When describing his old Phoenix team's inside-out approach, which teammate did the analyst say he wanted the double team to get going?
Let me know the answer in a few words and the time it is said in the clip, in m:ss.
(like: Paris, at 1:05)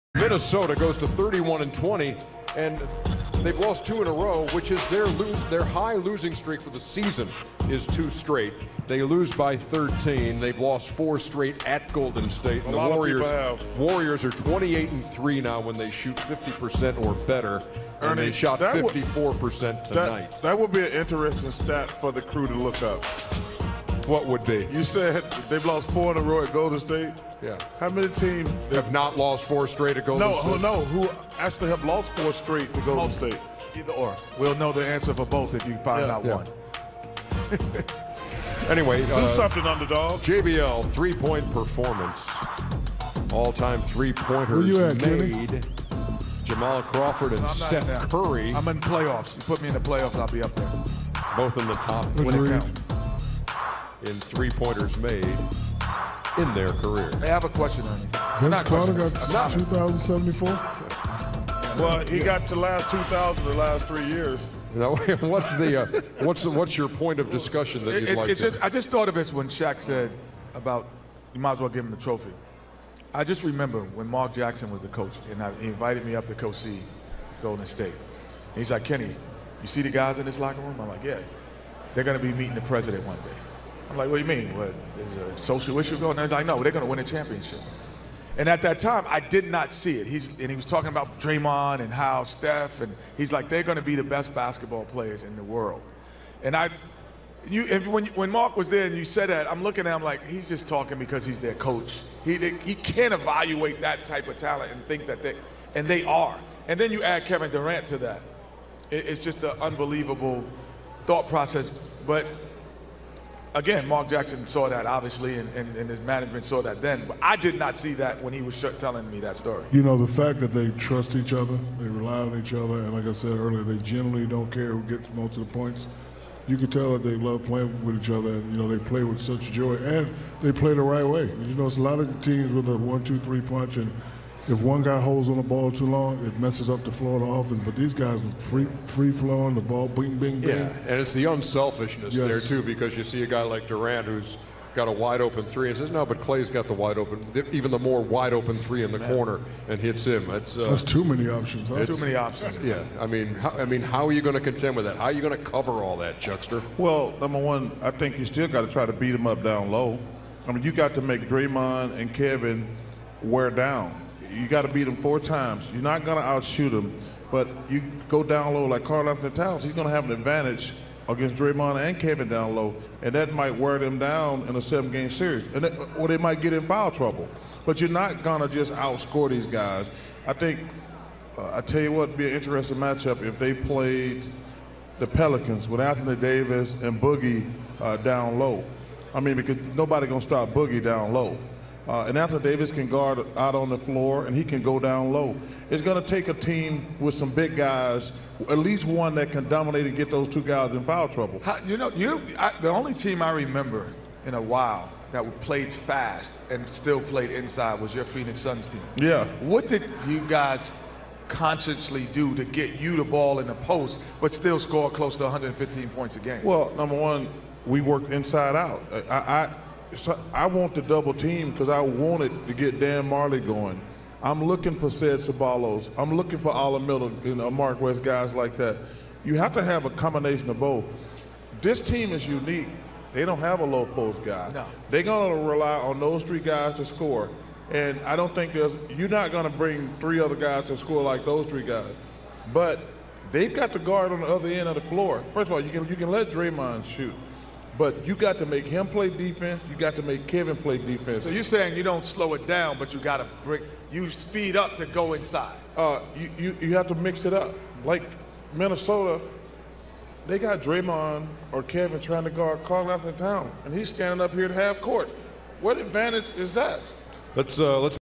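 Dan Majerle, at 3:42.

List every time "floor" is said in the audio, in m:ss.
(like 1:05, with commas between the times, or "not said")
3:13, 4:04.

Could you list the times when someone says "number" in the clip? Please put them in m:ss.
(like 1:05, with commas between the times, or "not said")
2:37, 3:36.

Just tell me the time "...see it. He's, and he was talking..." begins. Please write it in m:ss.
1:29.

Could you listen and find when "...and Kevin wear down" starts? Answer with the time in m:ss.
2:41.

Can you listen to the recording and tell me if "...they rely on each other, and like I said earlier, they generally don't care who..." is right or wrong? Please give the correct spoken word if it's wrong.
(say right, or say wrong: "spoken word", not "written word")
right.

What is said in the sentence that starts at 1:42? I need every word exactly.
He, they, he can't evaluate that type of talent and think that they, and they are.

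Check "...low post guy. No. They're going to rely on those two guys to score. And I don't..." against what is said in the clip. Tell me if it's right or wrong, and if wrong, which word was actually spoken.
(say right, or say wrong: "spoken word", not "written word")
wrong: "three", not "two".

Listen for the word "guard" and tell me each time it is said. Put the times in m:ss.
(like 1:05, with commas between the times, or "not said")
3:12, 4:03, 4:22.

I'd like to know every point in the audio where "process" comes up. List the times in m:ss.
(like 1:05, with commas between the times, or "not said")
1:51.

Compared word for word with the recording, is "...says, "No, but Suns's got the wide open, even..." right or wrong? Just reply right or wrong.
wrong.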